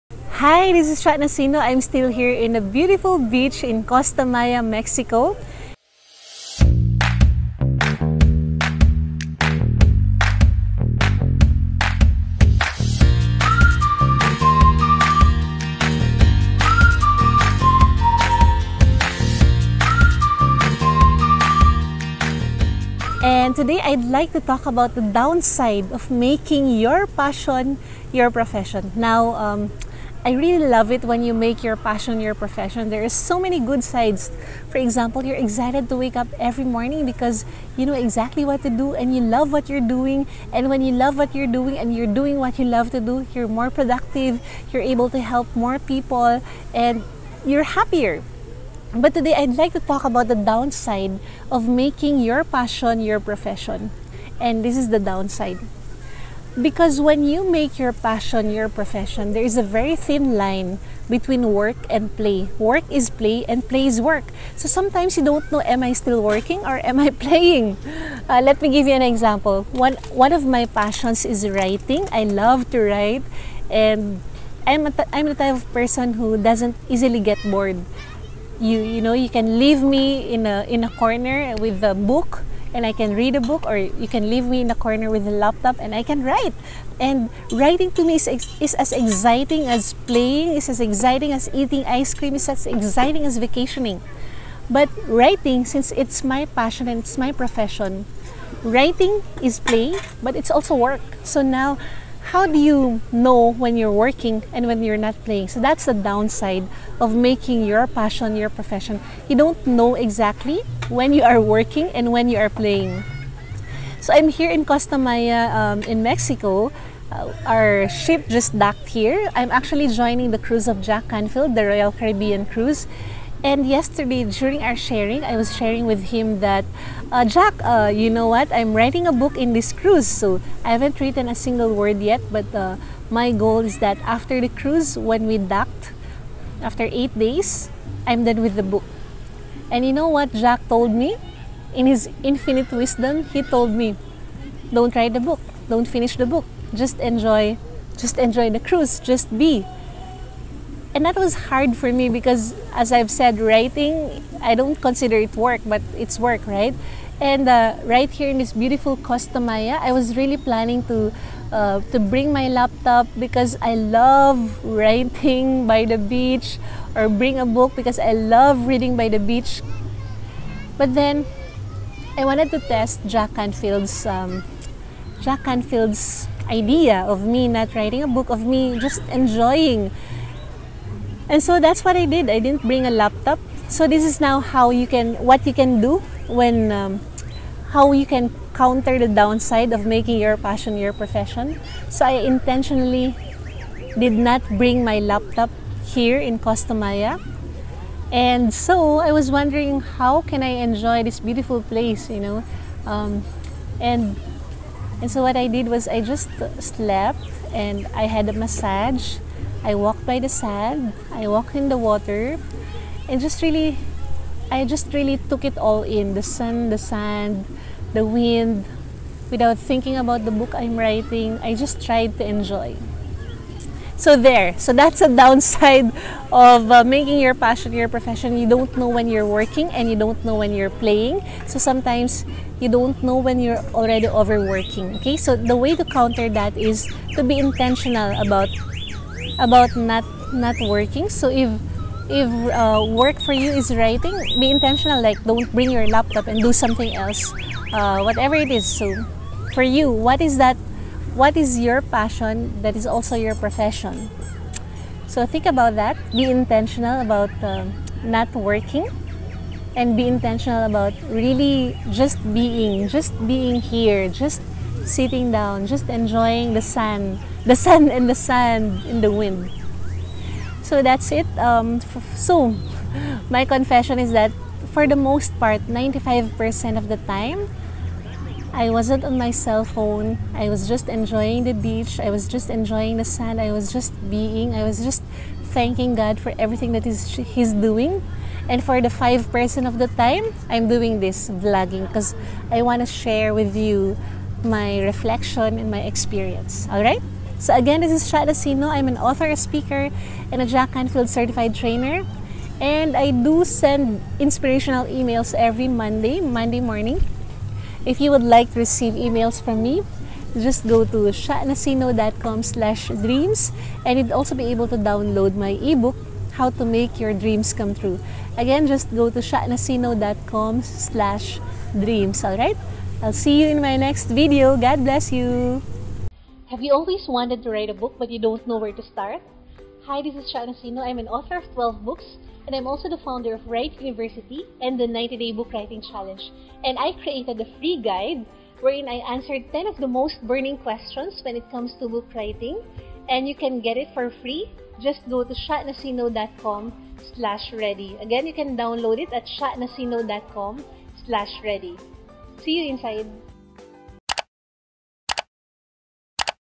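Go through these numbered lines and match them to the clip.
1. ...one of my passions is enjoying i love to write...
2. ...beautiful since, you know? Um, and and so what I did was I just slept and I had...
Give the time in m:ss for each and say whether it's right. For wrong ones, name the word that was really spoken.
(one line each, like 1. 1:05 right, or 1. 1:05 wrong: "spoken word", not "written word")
1. 1:10 wrong: "writing", not "enjoying"
2. 3:21 wrong: "place", not "since".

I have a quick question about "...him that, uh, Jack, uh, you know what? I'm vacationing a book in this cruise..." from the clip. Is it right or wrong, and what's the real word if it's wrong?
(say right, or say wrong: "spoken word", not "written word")
wrong: "writing", not "vacationing".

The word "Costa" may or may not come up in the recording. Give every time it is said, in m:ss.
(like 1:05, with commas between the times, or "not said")
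0:03, 1:54, 2:38, 3:16.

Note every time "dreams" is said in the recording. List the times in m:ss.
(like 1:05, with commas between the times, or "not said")
5:12, 5:17, 5:21.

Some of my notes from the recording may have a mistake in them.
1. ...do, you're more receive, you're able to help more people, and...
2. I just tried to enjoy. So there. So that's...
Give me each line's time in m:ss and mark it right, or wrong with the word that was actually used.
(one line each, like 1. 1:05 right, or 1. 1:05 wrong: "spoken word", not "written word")
1. 0:43 wrong: "productive", not "receive"
2. 3:41 right.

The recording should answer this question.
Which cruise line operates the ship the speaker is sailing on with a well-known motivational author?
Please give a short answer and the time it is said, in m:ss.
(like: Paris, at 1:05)
Royal Caribbean, at 2:01.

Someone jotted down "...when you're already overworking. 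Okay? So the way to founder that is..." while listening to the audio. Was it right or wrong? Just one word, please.
wrong.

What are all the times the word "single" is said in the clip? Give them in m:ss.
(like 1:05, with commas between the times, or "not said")
2:11.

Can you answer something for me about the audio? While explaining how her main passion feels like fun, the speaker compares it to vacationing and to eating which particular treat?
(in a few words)
ice cream.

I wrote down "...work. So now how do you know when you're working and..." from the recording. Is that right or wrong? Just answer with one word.
right.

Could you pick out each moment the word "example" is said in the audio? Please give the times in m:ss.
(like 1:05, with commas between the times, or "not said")
0:34, 1:09.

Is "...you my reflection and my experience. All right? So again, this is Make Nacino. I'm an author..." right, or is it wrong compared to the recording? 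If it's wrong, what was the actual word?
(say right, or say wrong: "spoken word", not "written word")
wrong: "Sha", not "Make".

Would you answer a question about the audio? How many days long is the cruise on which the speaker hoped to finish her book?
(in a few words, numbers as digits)
8.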